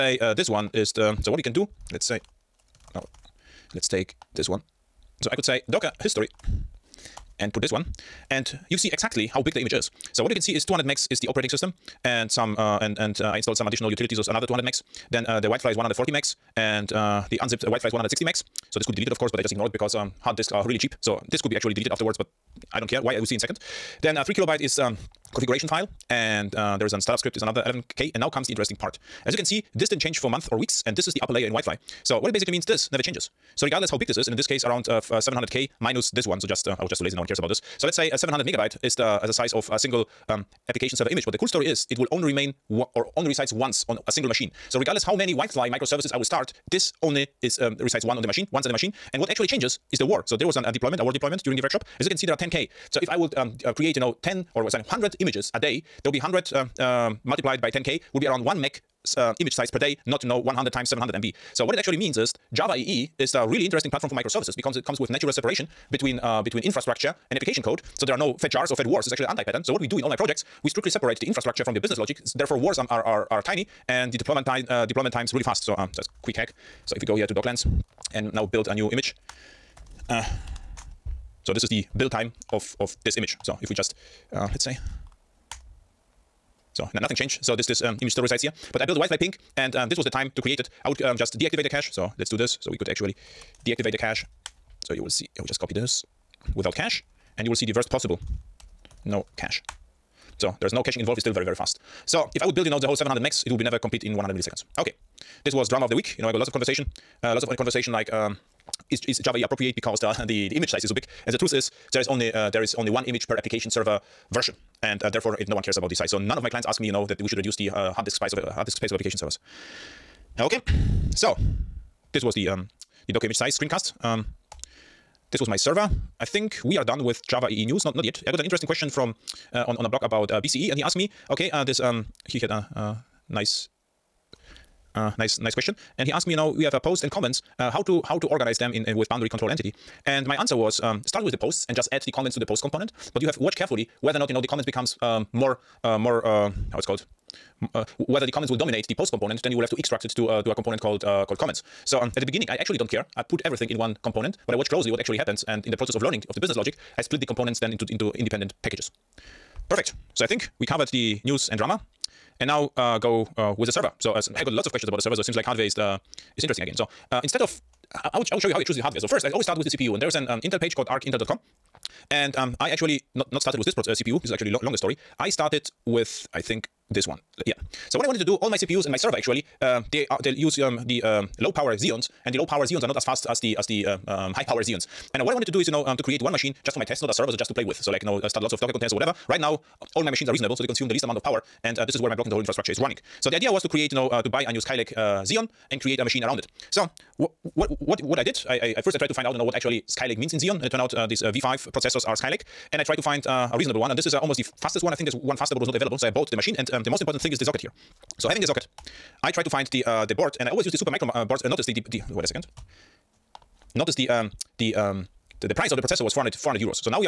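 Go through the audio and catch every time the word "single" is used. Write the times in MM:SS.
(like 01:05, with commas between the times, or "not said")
00:39, 00:44.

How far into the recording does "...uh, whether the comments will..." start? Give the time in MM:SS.
02:27.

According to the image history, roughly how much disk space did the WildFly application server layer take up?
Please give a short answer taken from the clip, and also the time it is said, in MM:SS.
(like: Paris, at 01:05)
140 MB, at 00:15.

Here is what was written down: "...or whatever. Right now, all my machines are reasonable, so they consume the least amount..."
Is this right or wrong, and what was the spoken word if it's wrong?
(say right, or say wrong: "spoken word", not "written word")
right.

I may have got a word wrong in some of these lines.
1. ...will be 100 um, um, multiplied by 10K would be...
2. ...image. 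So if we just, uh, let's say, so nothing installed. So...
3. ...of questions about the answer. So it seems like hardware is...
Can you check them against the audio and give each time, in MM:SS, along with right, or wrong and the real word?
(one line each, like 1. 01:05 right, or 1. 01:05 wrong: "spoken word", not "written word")
1. 00:56 right
2. 01:23 wrong: "changed", not "installed"
3. 02:44 wrong: "server", not "answer".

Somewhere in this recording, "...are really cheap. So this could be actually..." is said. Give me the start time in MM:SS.
00:20.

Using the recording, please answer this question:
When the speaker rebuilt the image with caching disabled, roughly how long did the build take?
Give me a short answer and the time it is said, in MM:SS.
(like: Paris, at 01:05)
100 milliseconds, at 01:44.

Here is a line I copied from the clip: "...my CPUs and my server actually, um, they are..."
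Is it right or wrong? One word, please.
right.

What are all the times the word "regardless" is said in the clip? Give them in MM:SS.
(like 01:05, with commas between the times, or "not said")
00:33, 00:44.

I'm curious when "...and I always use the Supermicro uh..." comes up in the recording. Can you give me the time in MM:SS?
03:30.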